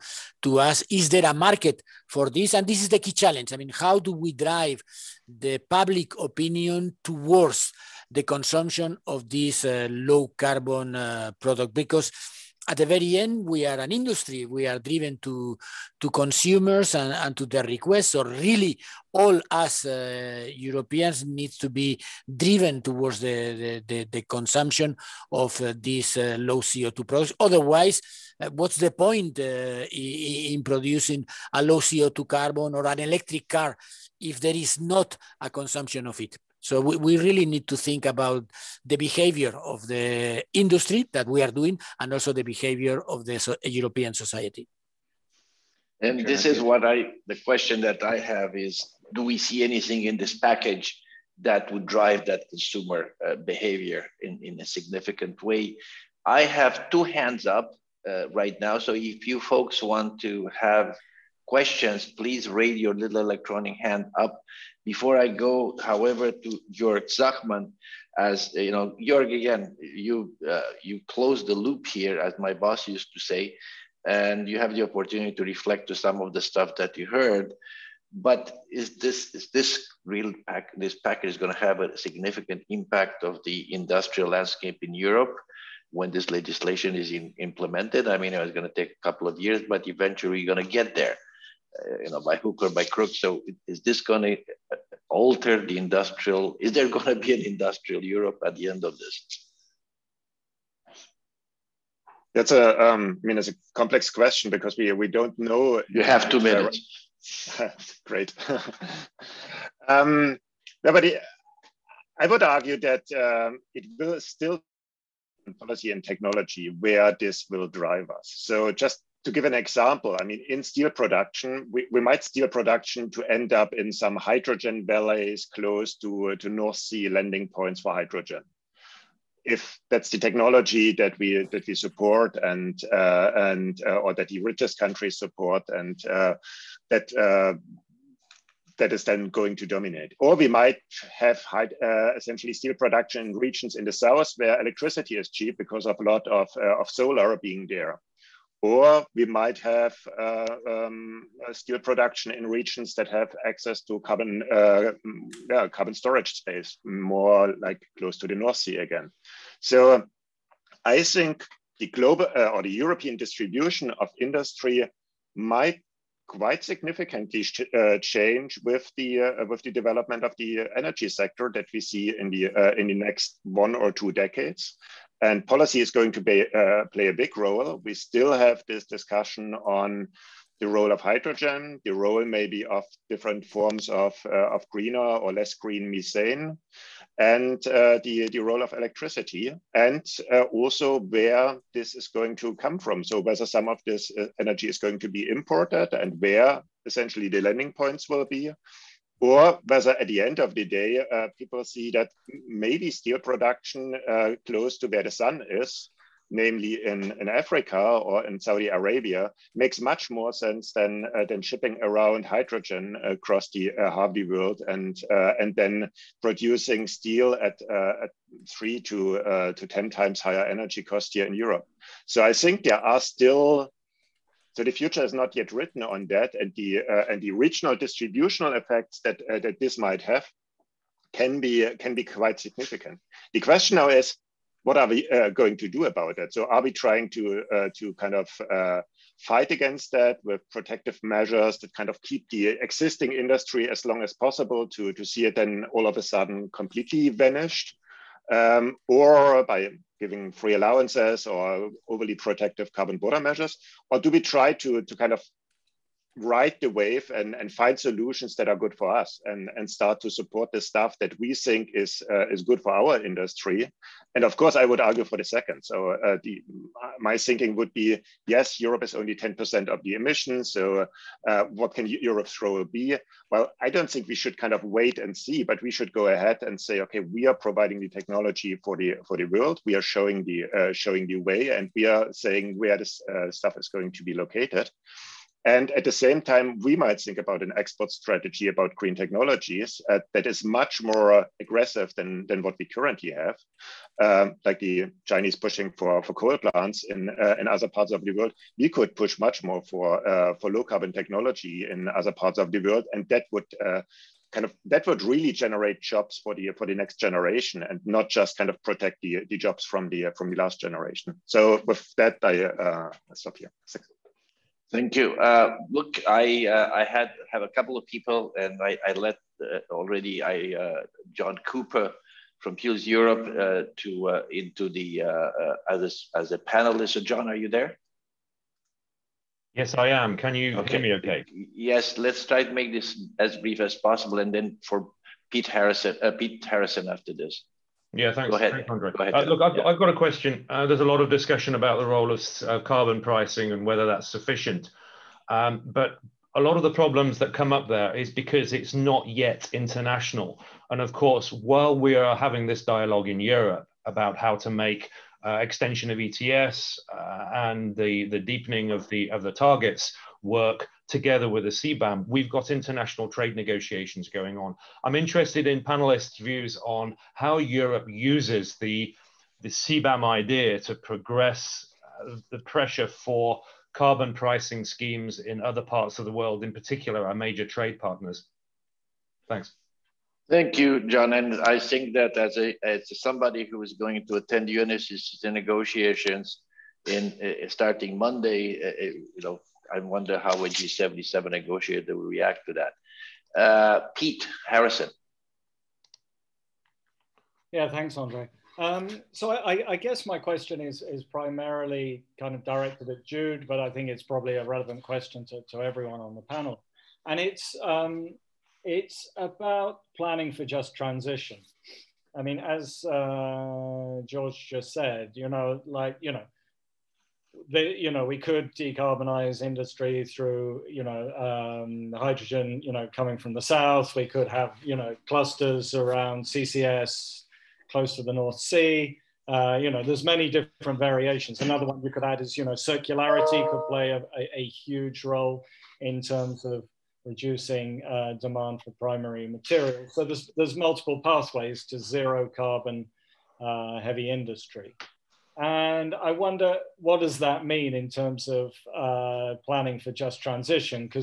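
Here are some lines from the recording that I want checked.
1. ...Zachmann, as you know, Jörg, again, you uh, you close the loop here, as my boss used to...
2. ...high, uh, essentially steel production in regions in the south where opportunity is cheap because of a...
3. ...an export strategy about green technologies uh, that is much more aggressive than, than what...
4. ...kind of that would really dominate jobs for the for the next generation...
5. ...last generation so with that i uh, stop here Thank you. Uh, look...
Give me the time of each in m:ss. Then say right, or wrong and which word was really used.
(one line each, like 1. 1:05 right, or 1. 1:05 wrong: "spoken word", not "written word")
1. 1:07 right
2. 2:21 wrong: "electricity", not "opportunity"
3. 4:47 right
4. 5:04 wrong: "generate", not "dominate"
5. 5:10 right.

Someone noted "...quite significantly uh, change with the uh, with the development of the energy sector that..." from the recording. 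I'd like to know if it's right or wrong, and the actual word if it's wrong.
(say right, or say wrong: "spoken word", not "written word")
right.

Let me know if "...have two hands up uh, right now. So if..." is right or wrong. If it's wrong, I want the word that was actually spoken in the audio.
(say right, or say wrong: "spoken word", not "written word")
right.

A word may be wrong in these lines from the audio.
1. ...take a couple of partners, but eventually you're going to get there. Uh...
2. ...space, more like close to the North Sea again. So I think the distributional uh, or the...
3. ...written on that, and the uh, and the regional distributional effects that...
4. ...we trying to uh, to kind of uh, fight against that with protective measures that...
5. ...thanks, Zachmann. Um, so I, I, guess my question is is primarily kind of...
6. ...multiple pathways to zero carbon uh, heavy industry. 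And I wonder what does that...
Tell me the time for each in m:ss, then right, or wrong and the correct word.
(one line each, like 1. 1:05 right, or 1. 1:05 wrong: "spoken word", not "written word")
1. 1:28 wrong: "years", not "partners"
2. 2:36 wrong: "global", not "distributional"
3. 3:45 right
4. 3:56 right
5. 6:37 wrong: "Andre", not "Zachmann"
6. 7:20 right.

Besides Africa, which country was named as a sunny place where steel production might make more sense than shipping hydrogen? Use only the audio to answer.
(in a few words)
Saudi Arabia.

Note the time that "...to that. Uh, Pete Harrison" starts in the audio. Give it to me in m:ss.
6:32.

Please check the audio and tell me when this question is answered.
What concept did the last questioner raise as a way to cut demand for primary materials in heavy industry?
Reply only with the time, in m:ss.
7:12.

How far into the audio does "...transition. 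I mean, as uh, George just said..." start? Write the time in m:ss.
6:50.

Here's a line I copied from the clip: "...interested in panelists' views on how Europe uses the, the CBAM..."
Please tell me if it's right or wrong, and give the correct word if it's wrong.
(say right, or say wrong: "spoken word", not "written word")
right.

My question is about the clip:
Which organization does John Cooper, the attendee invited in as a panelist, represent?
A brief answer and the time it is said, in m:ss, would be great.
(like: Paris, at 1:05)
FuelsEurope, at 5:22.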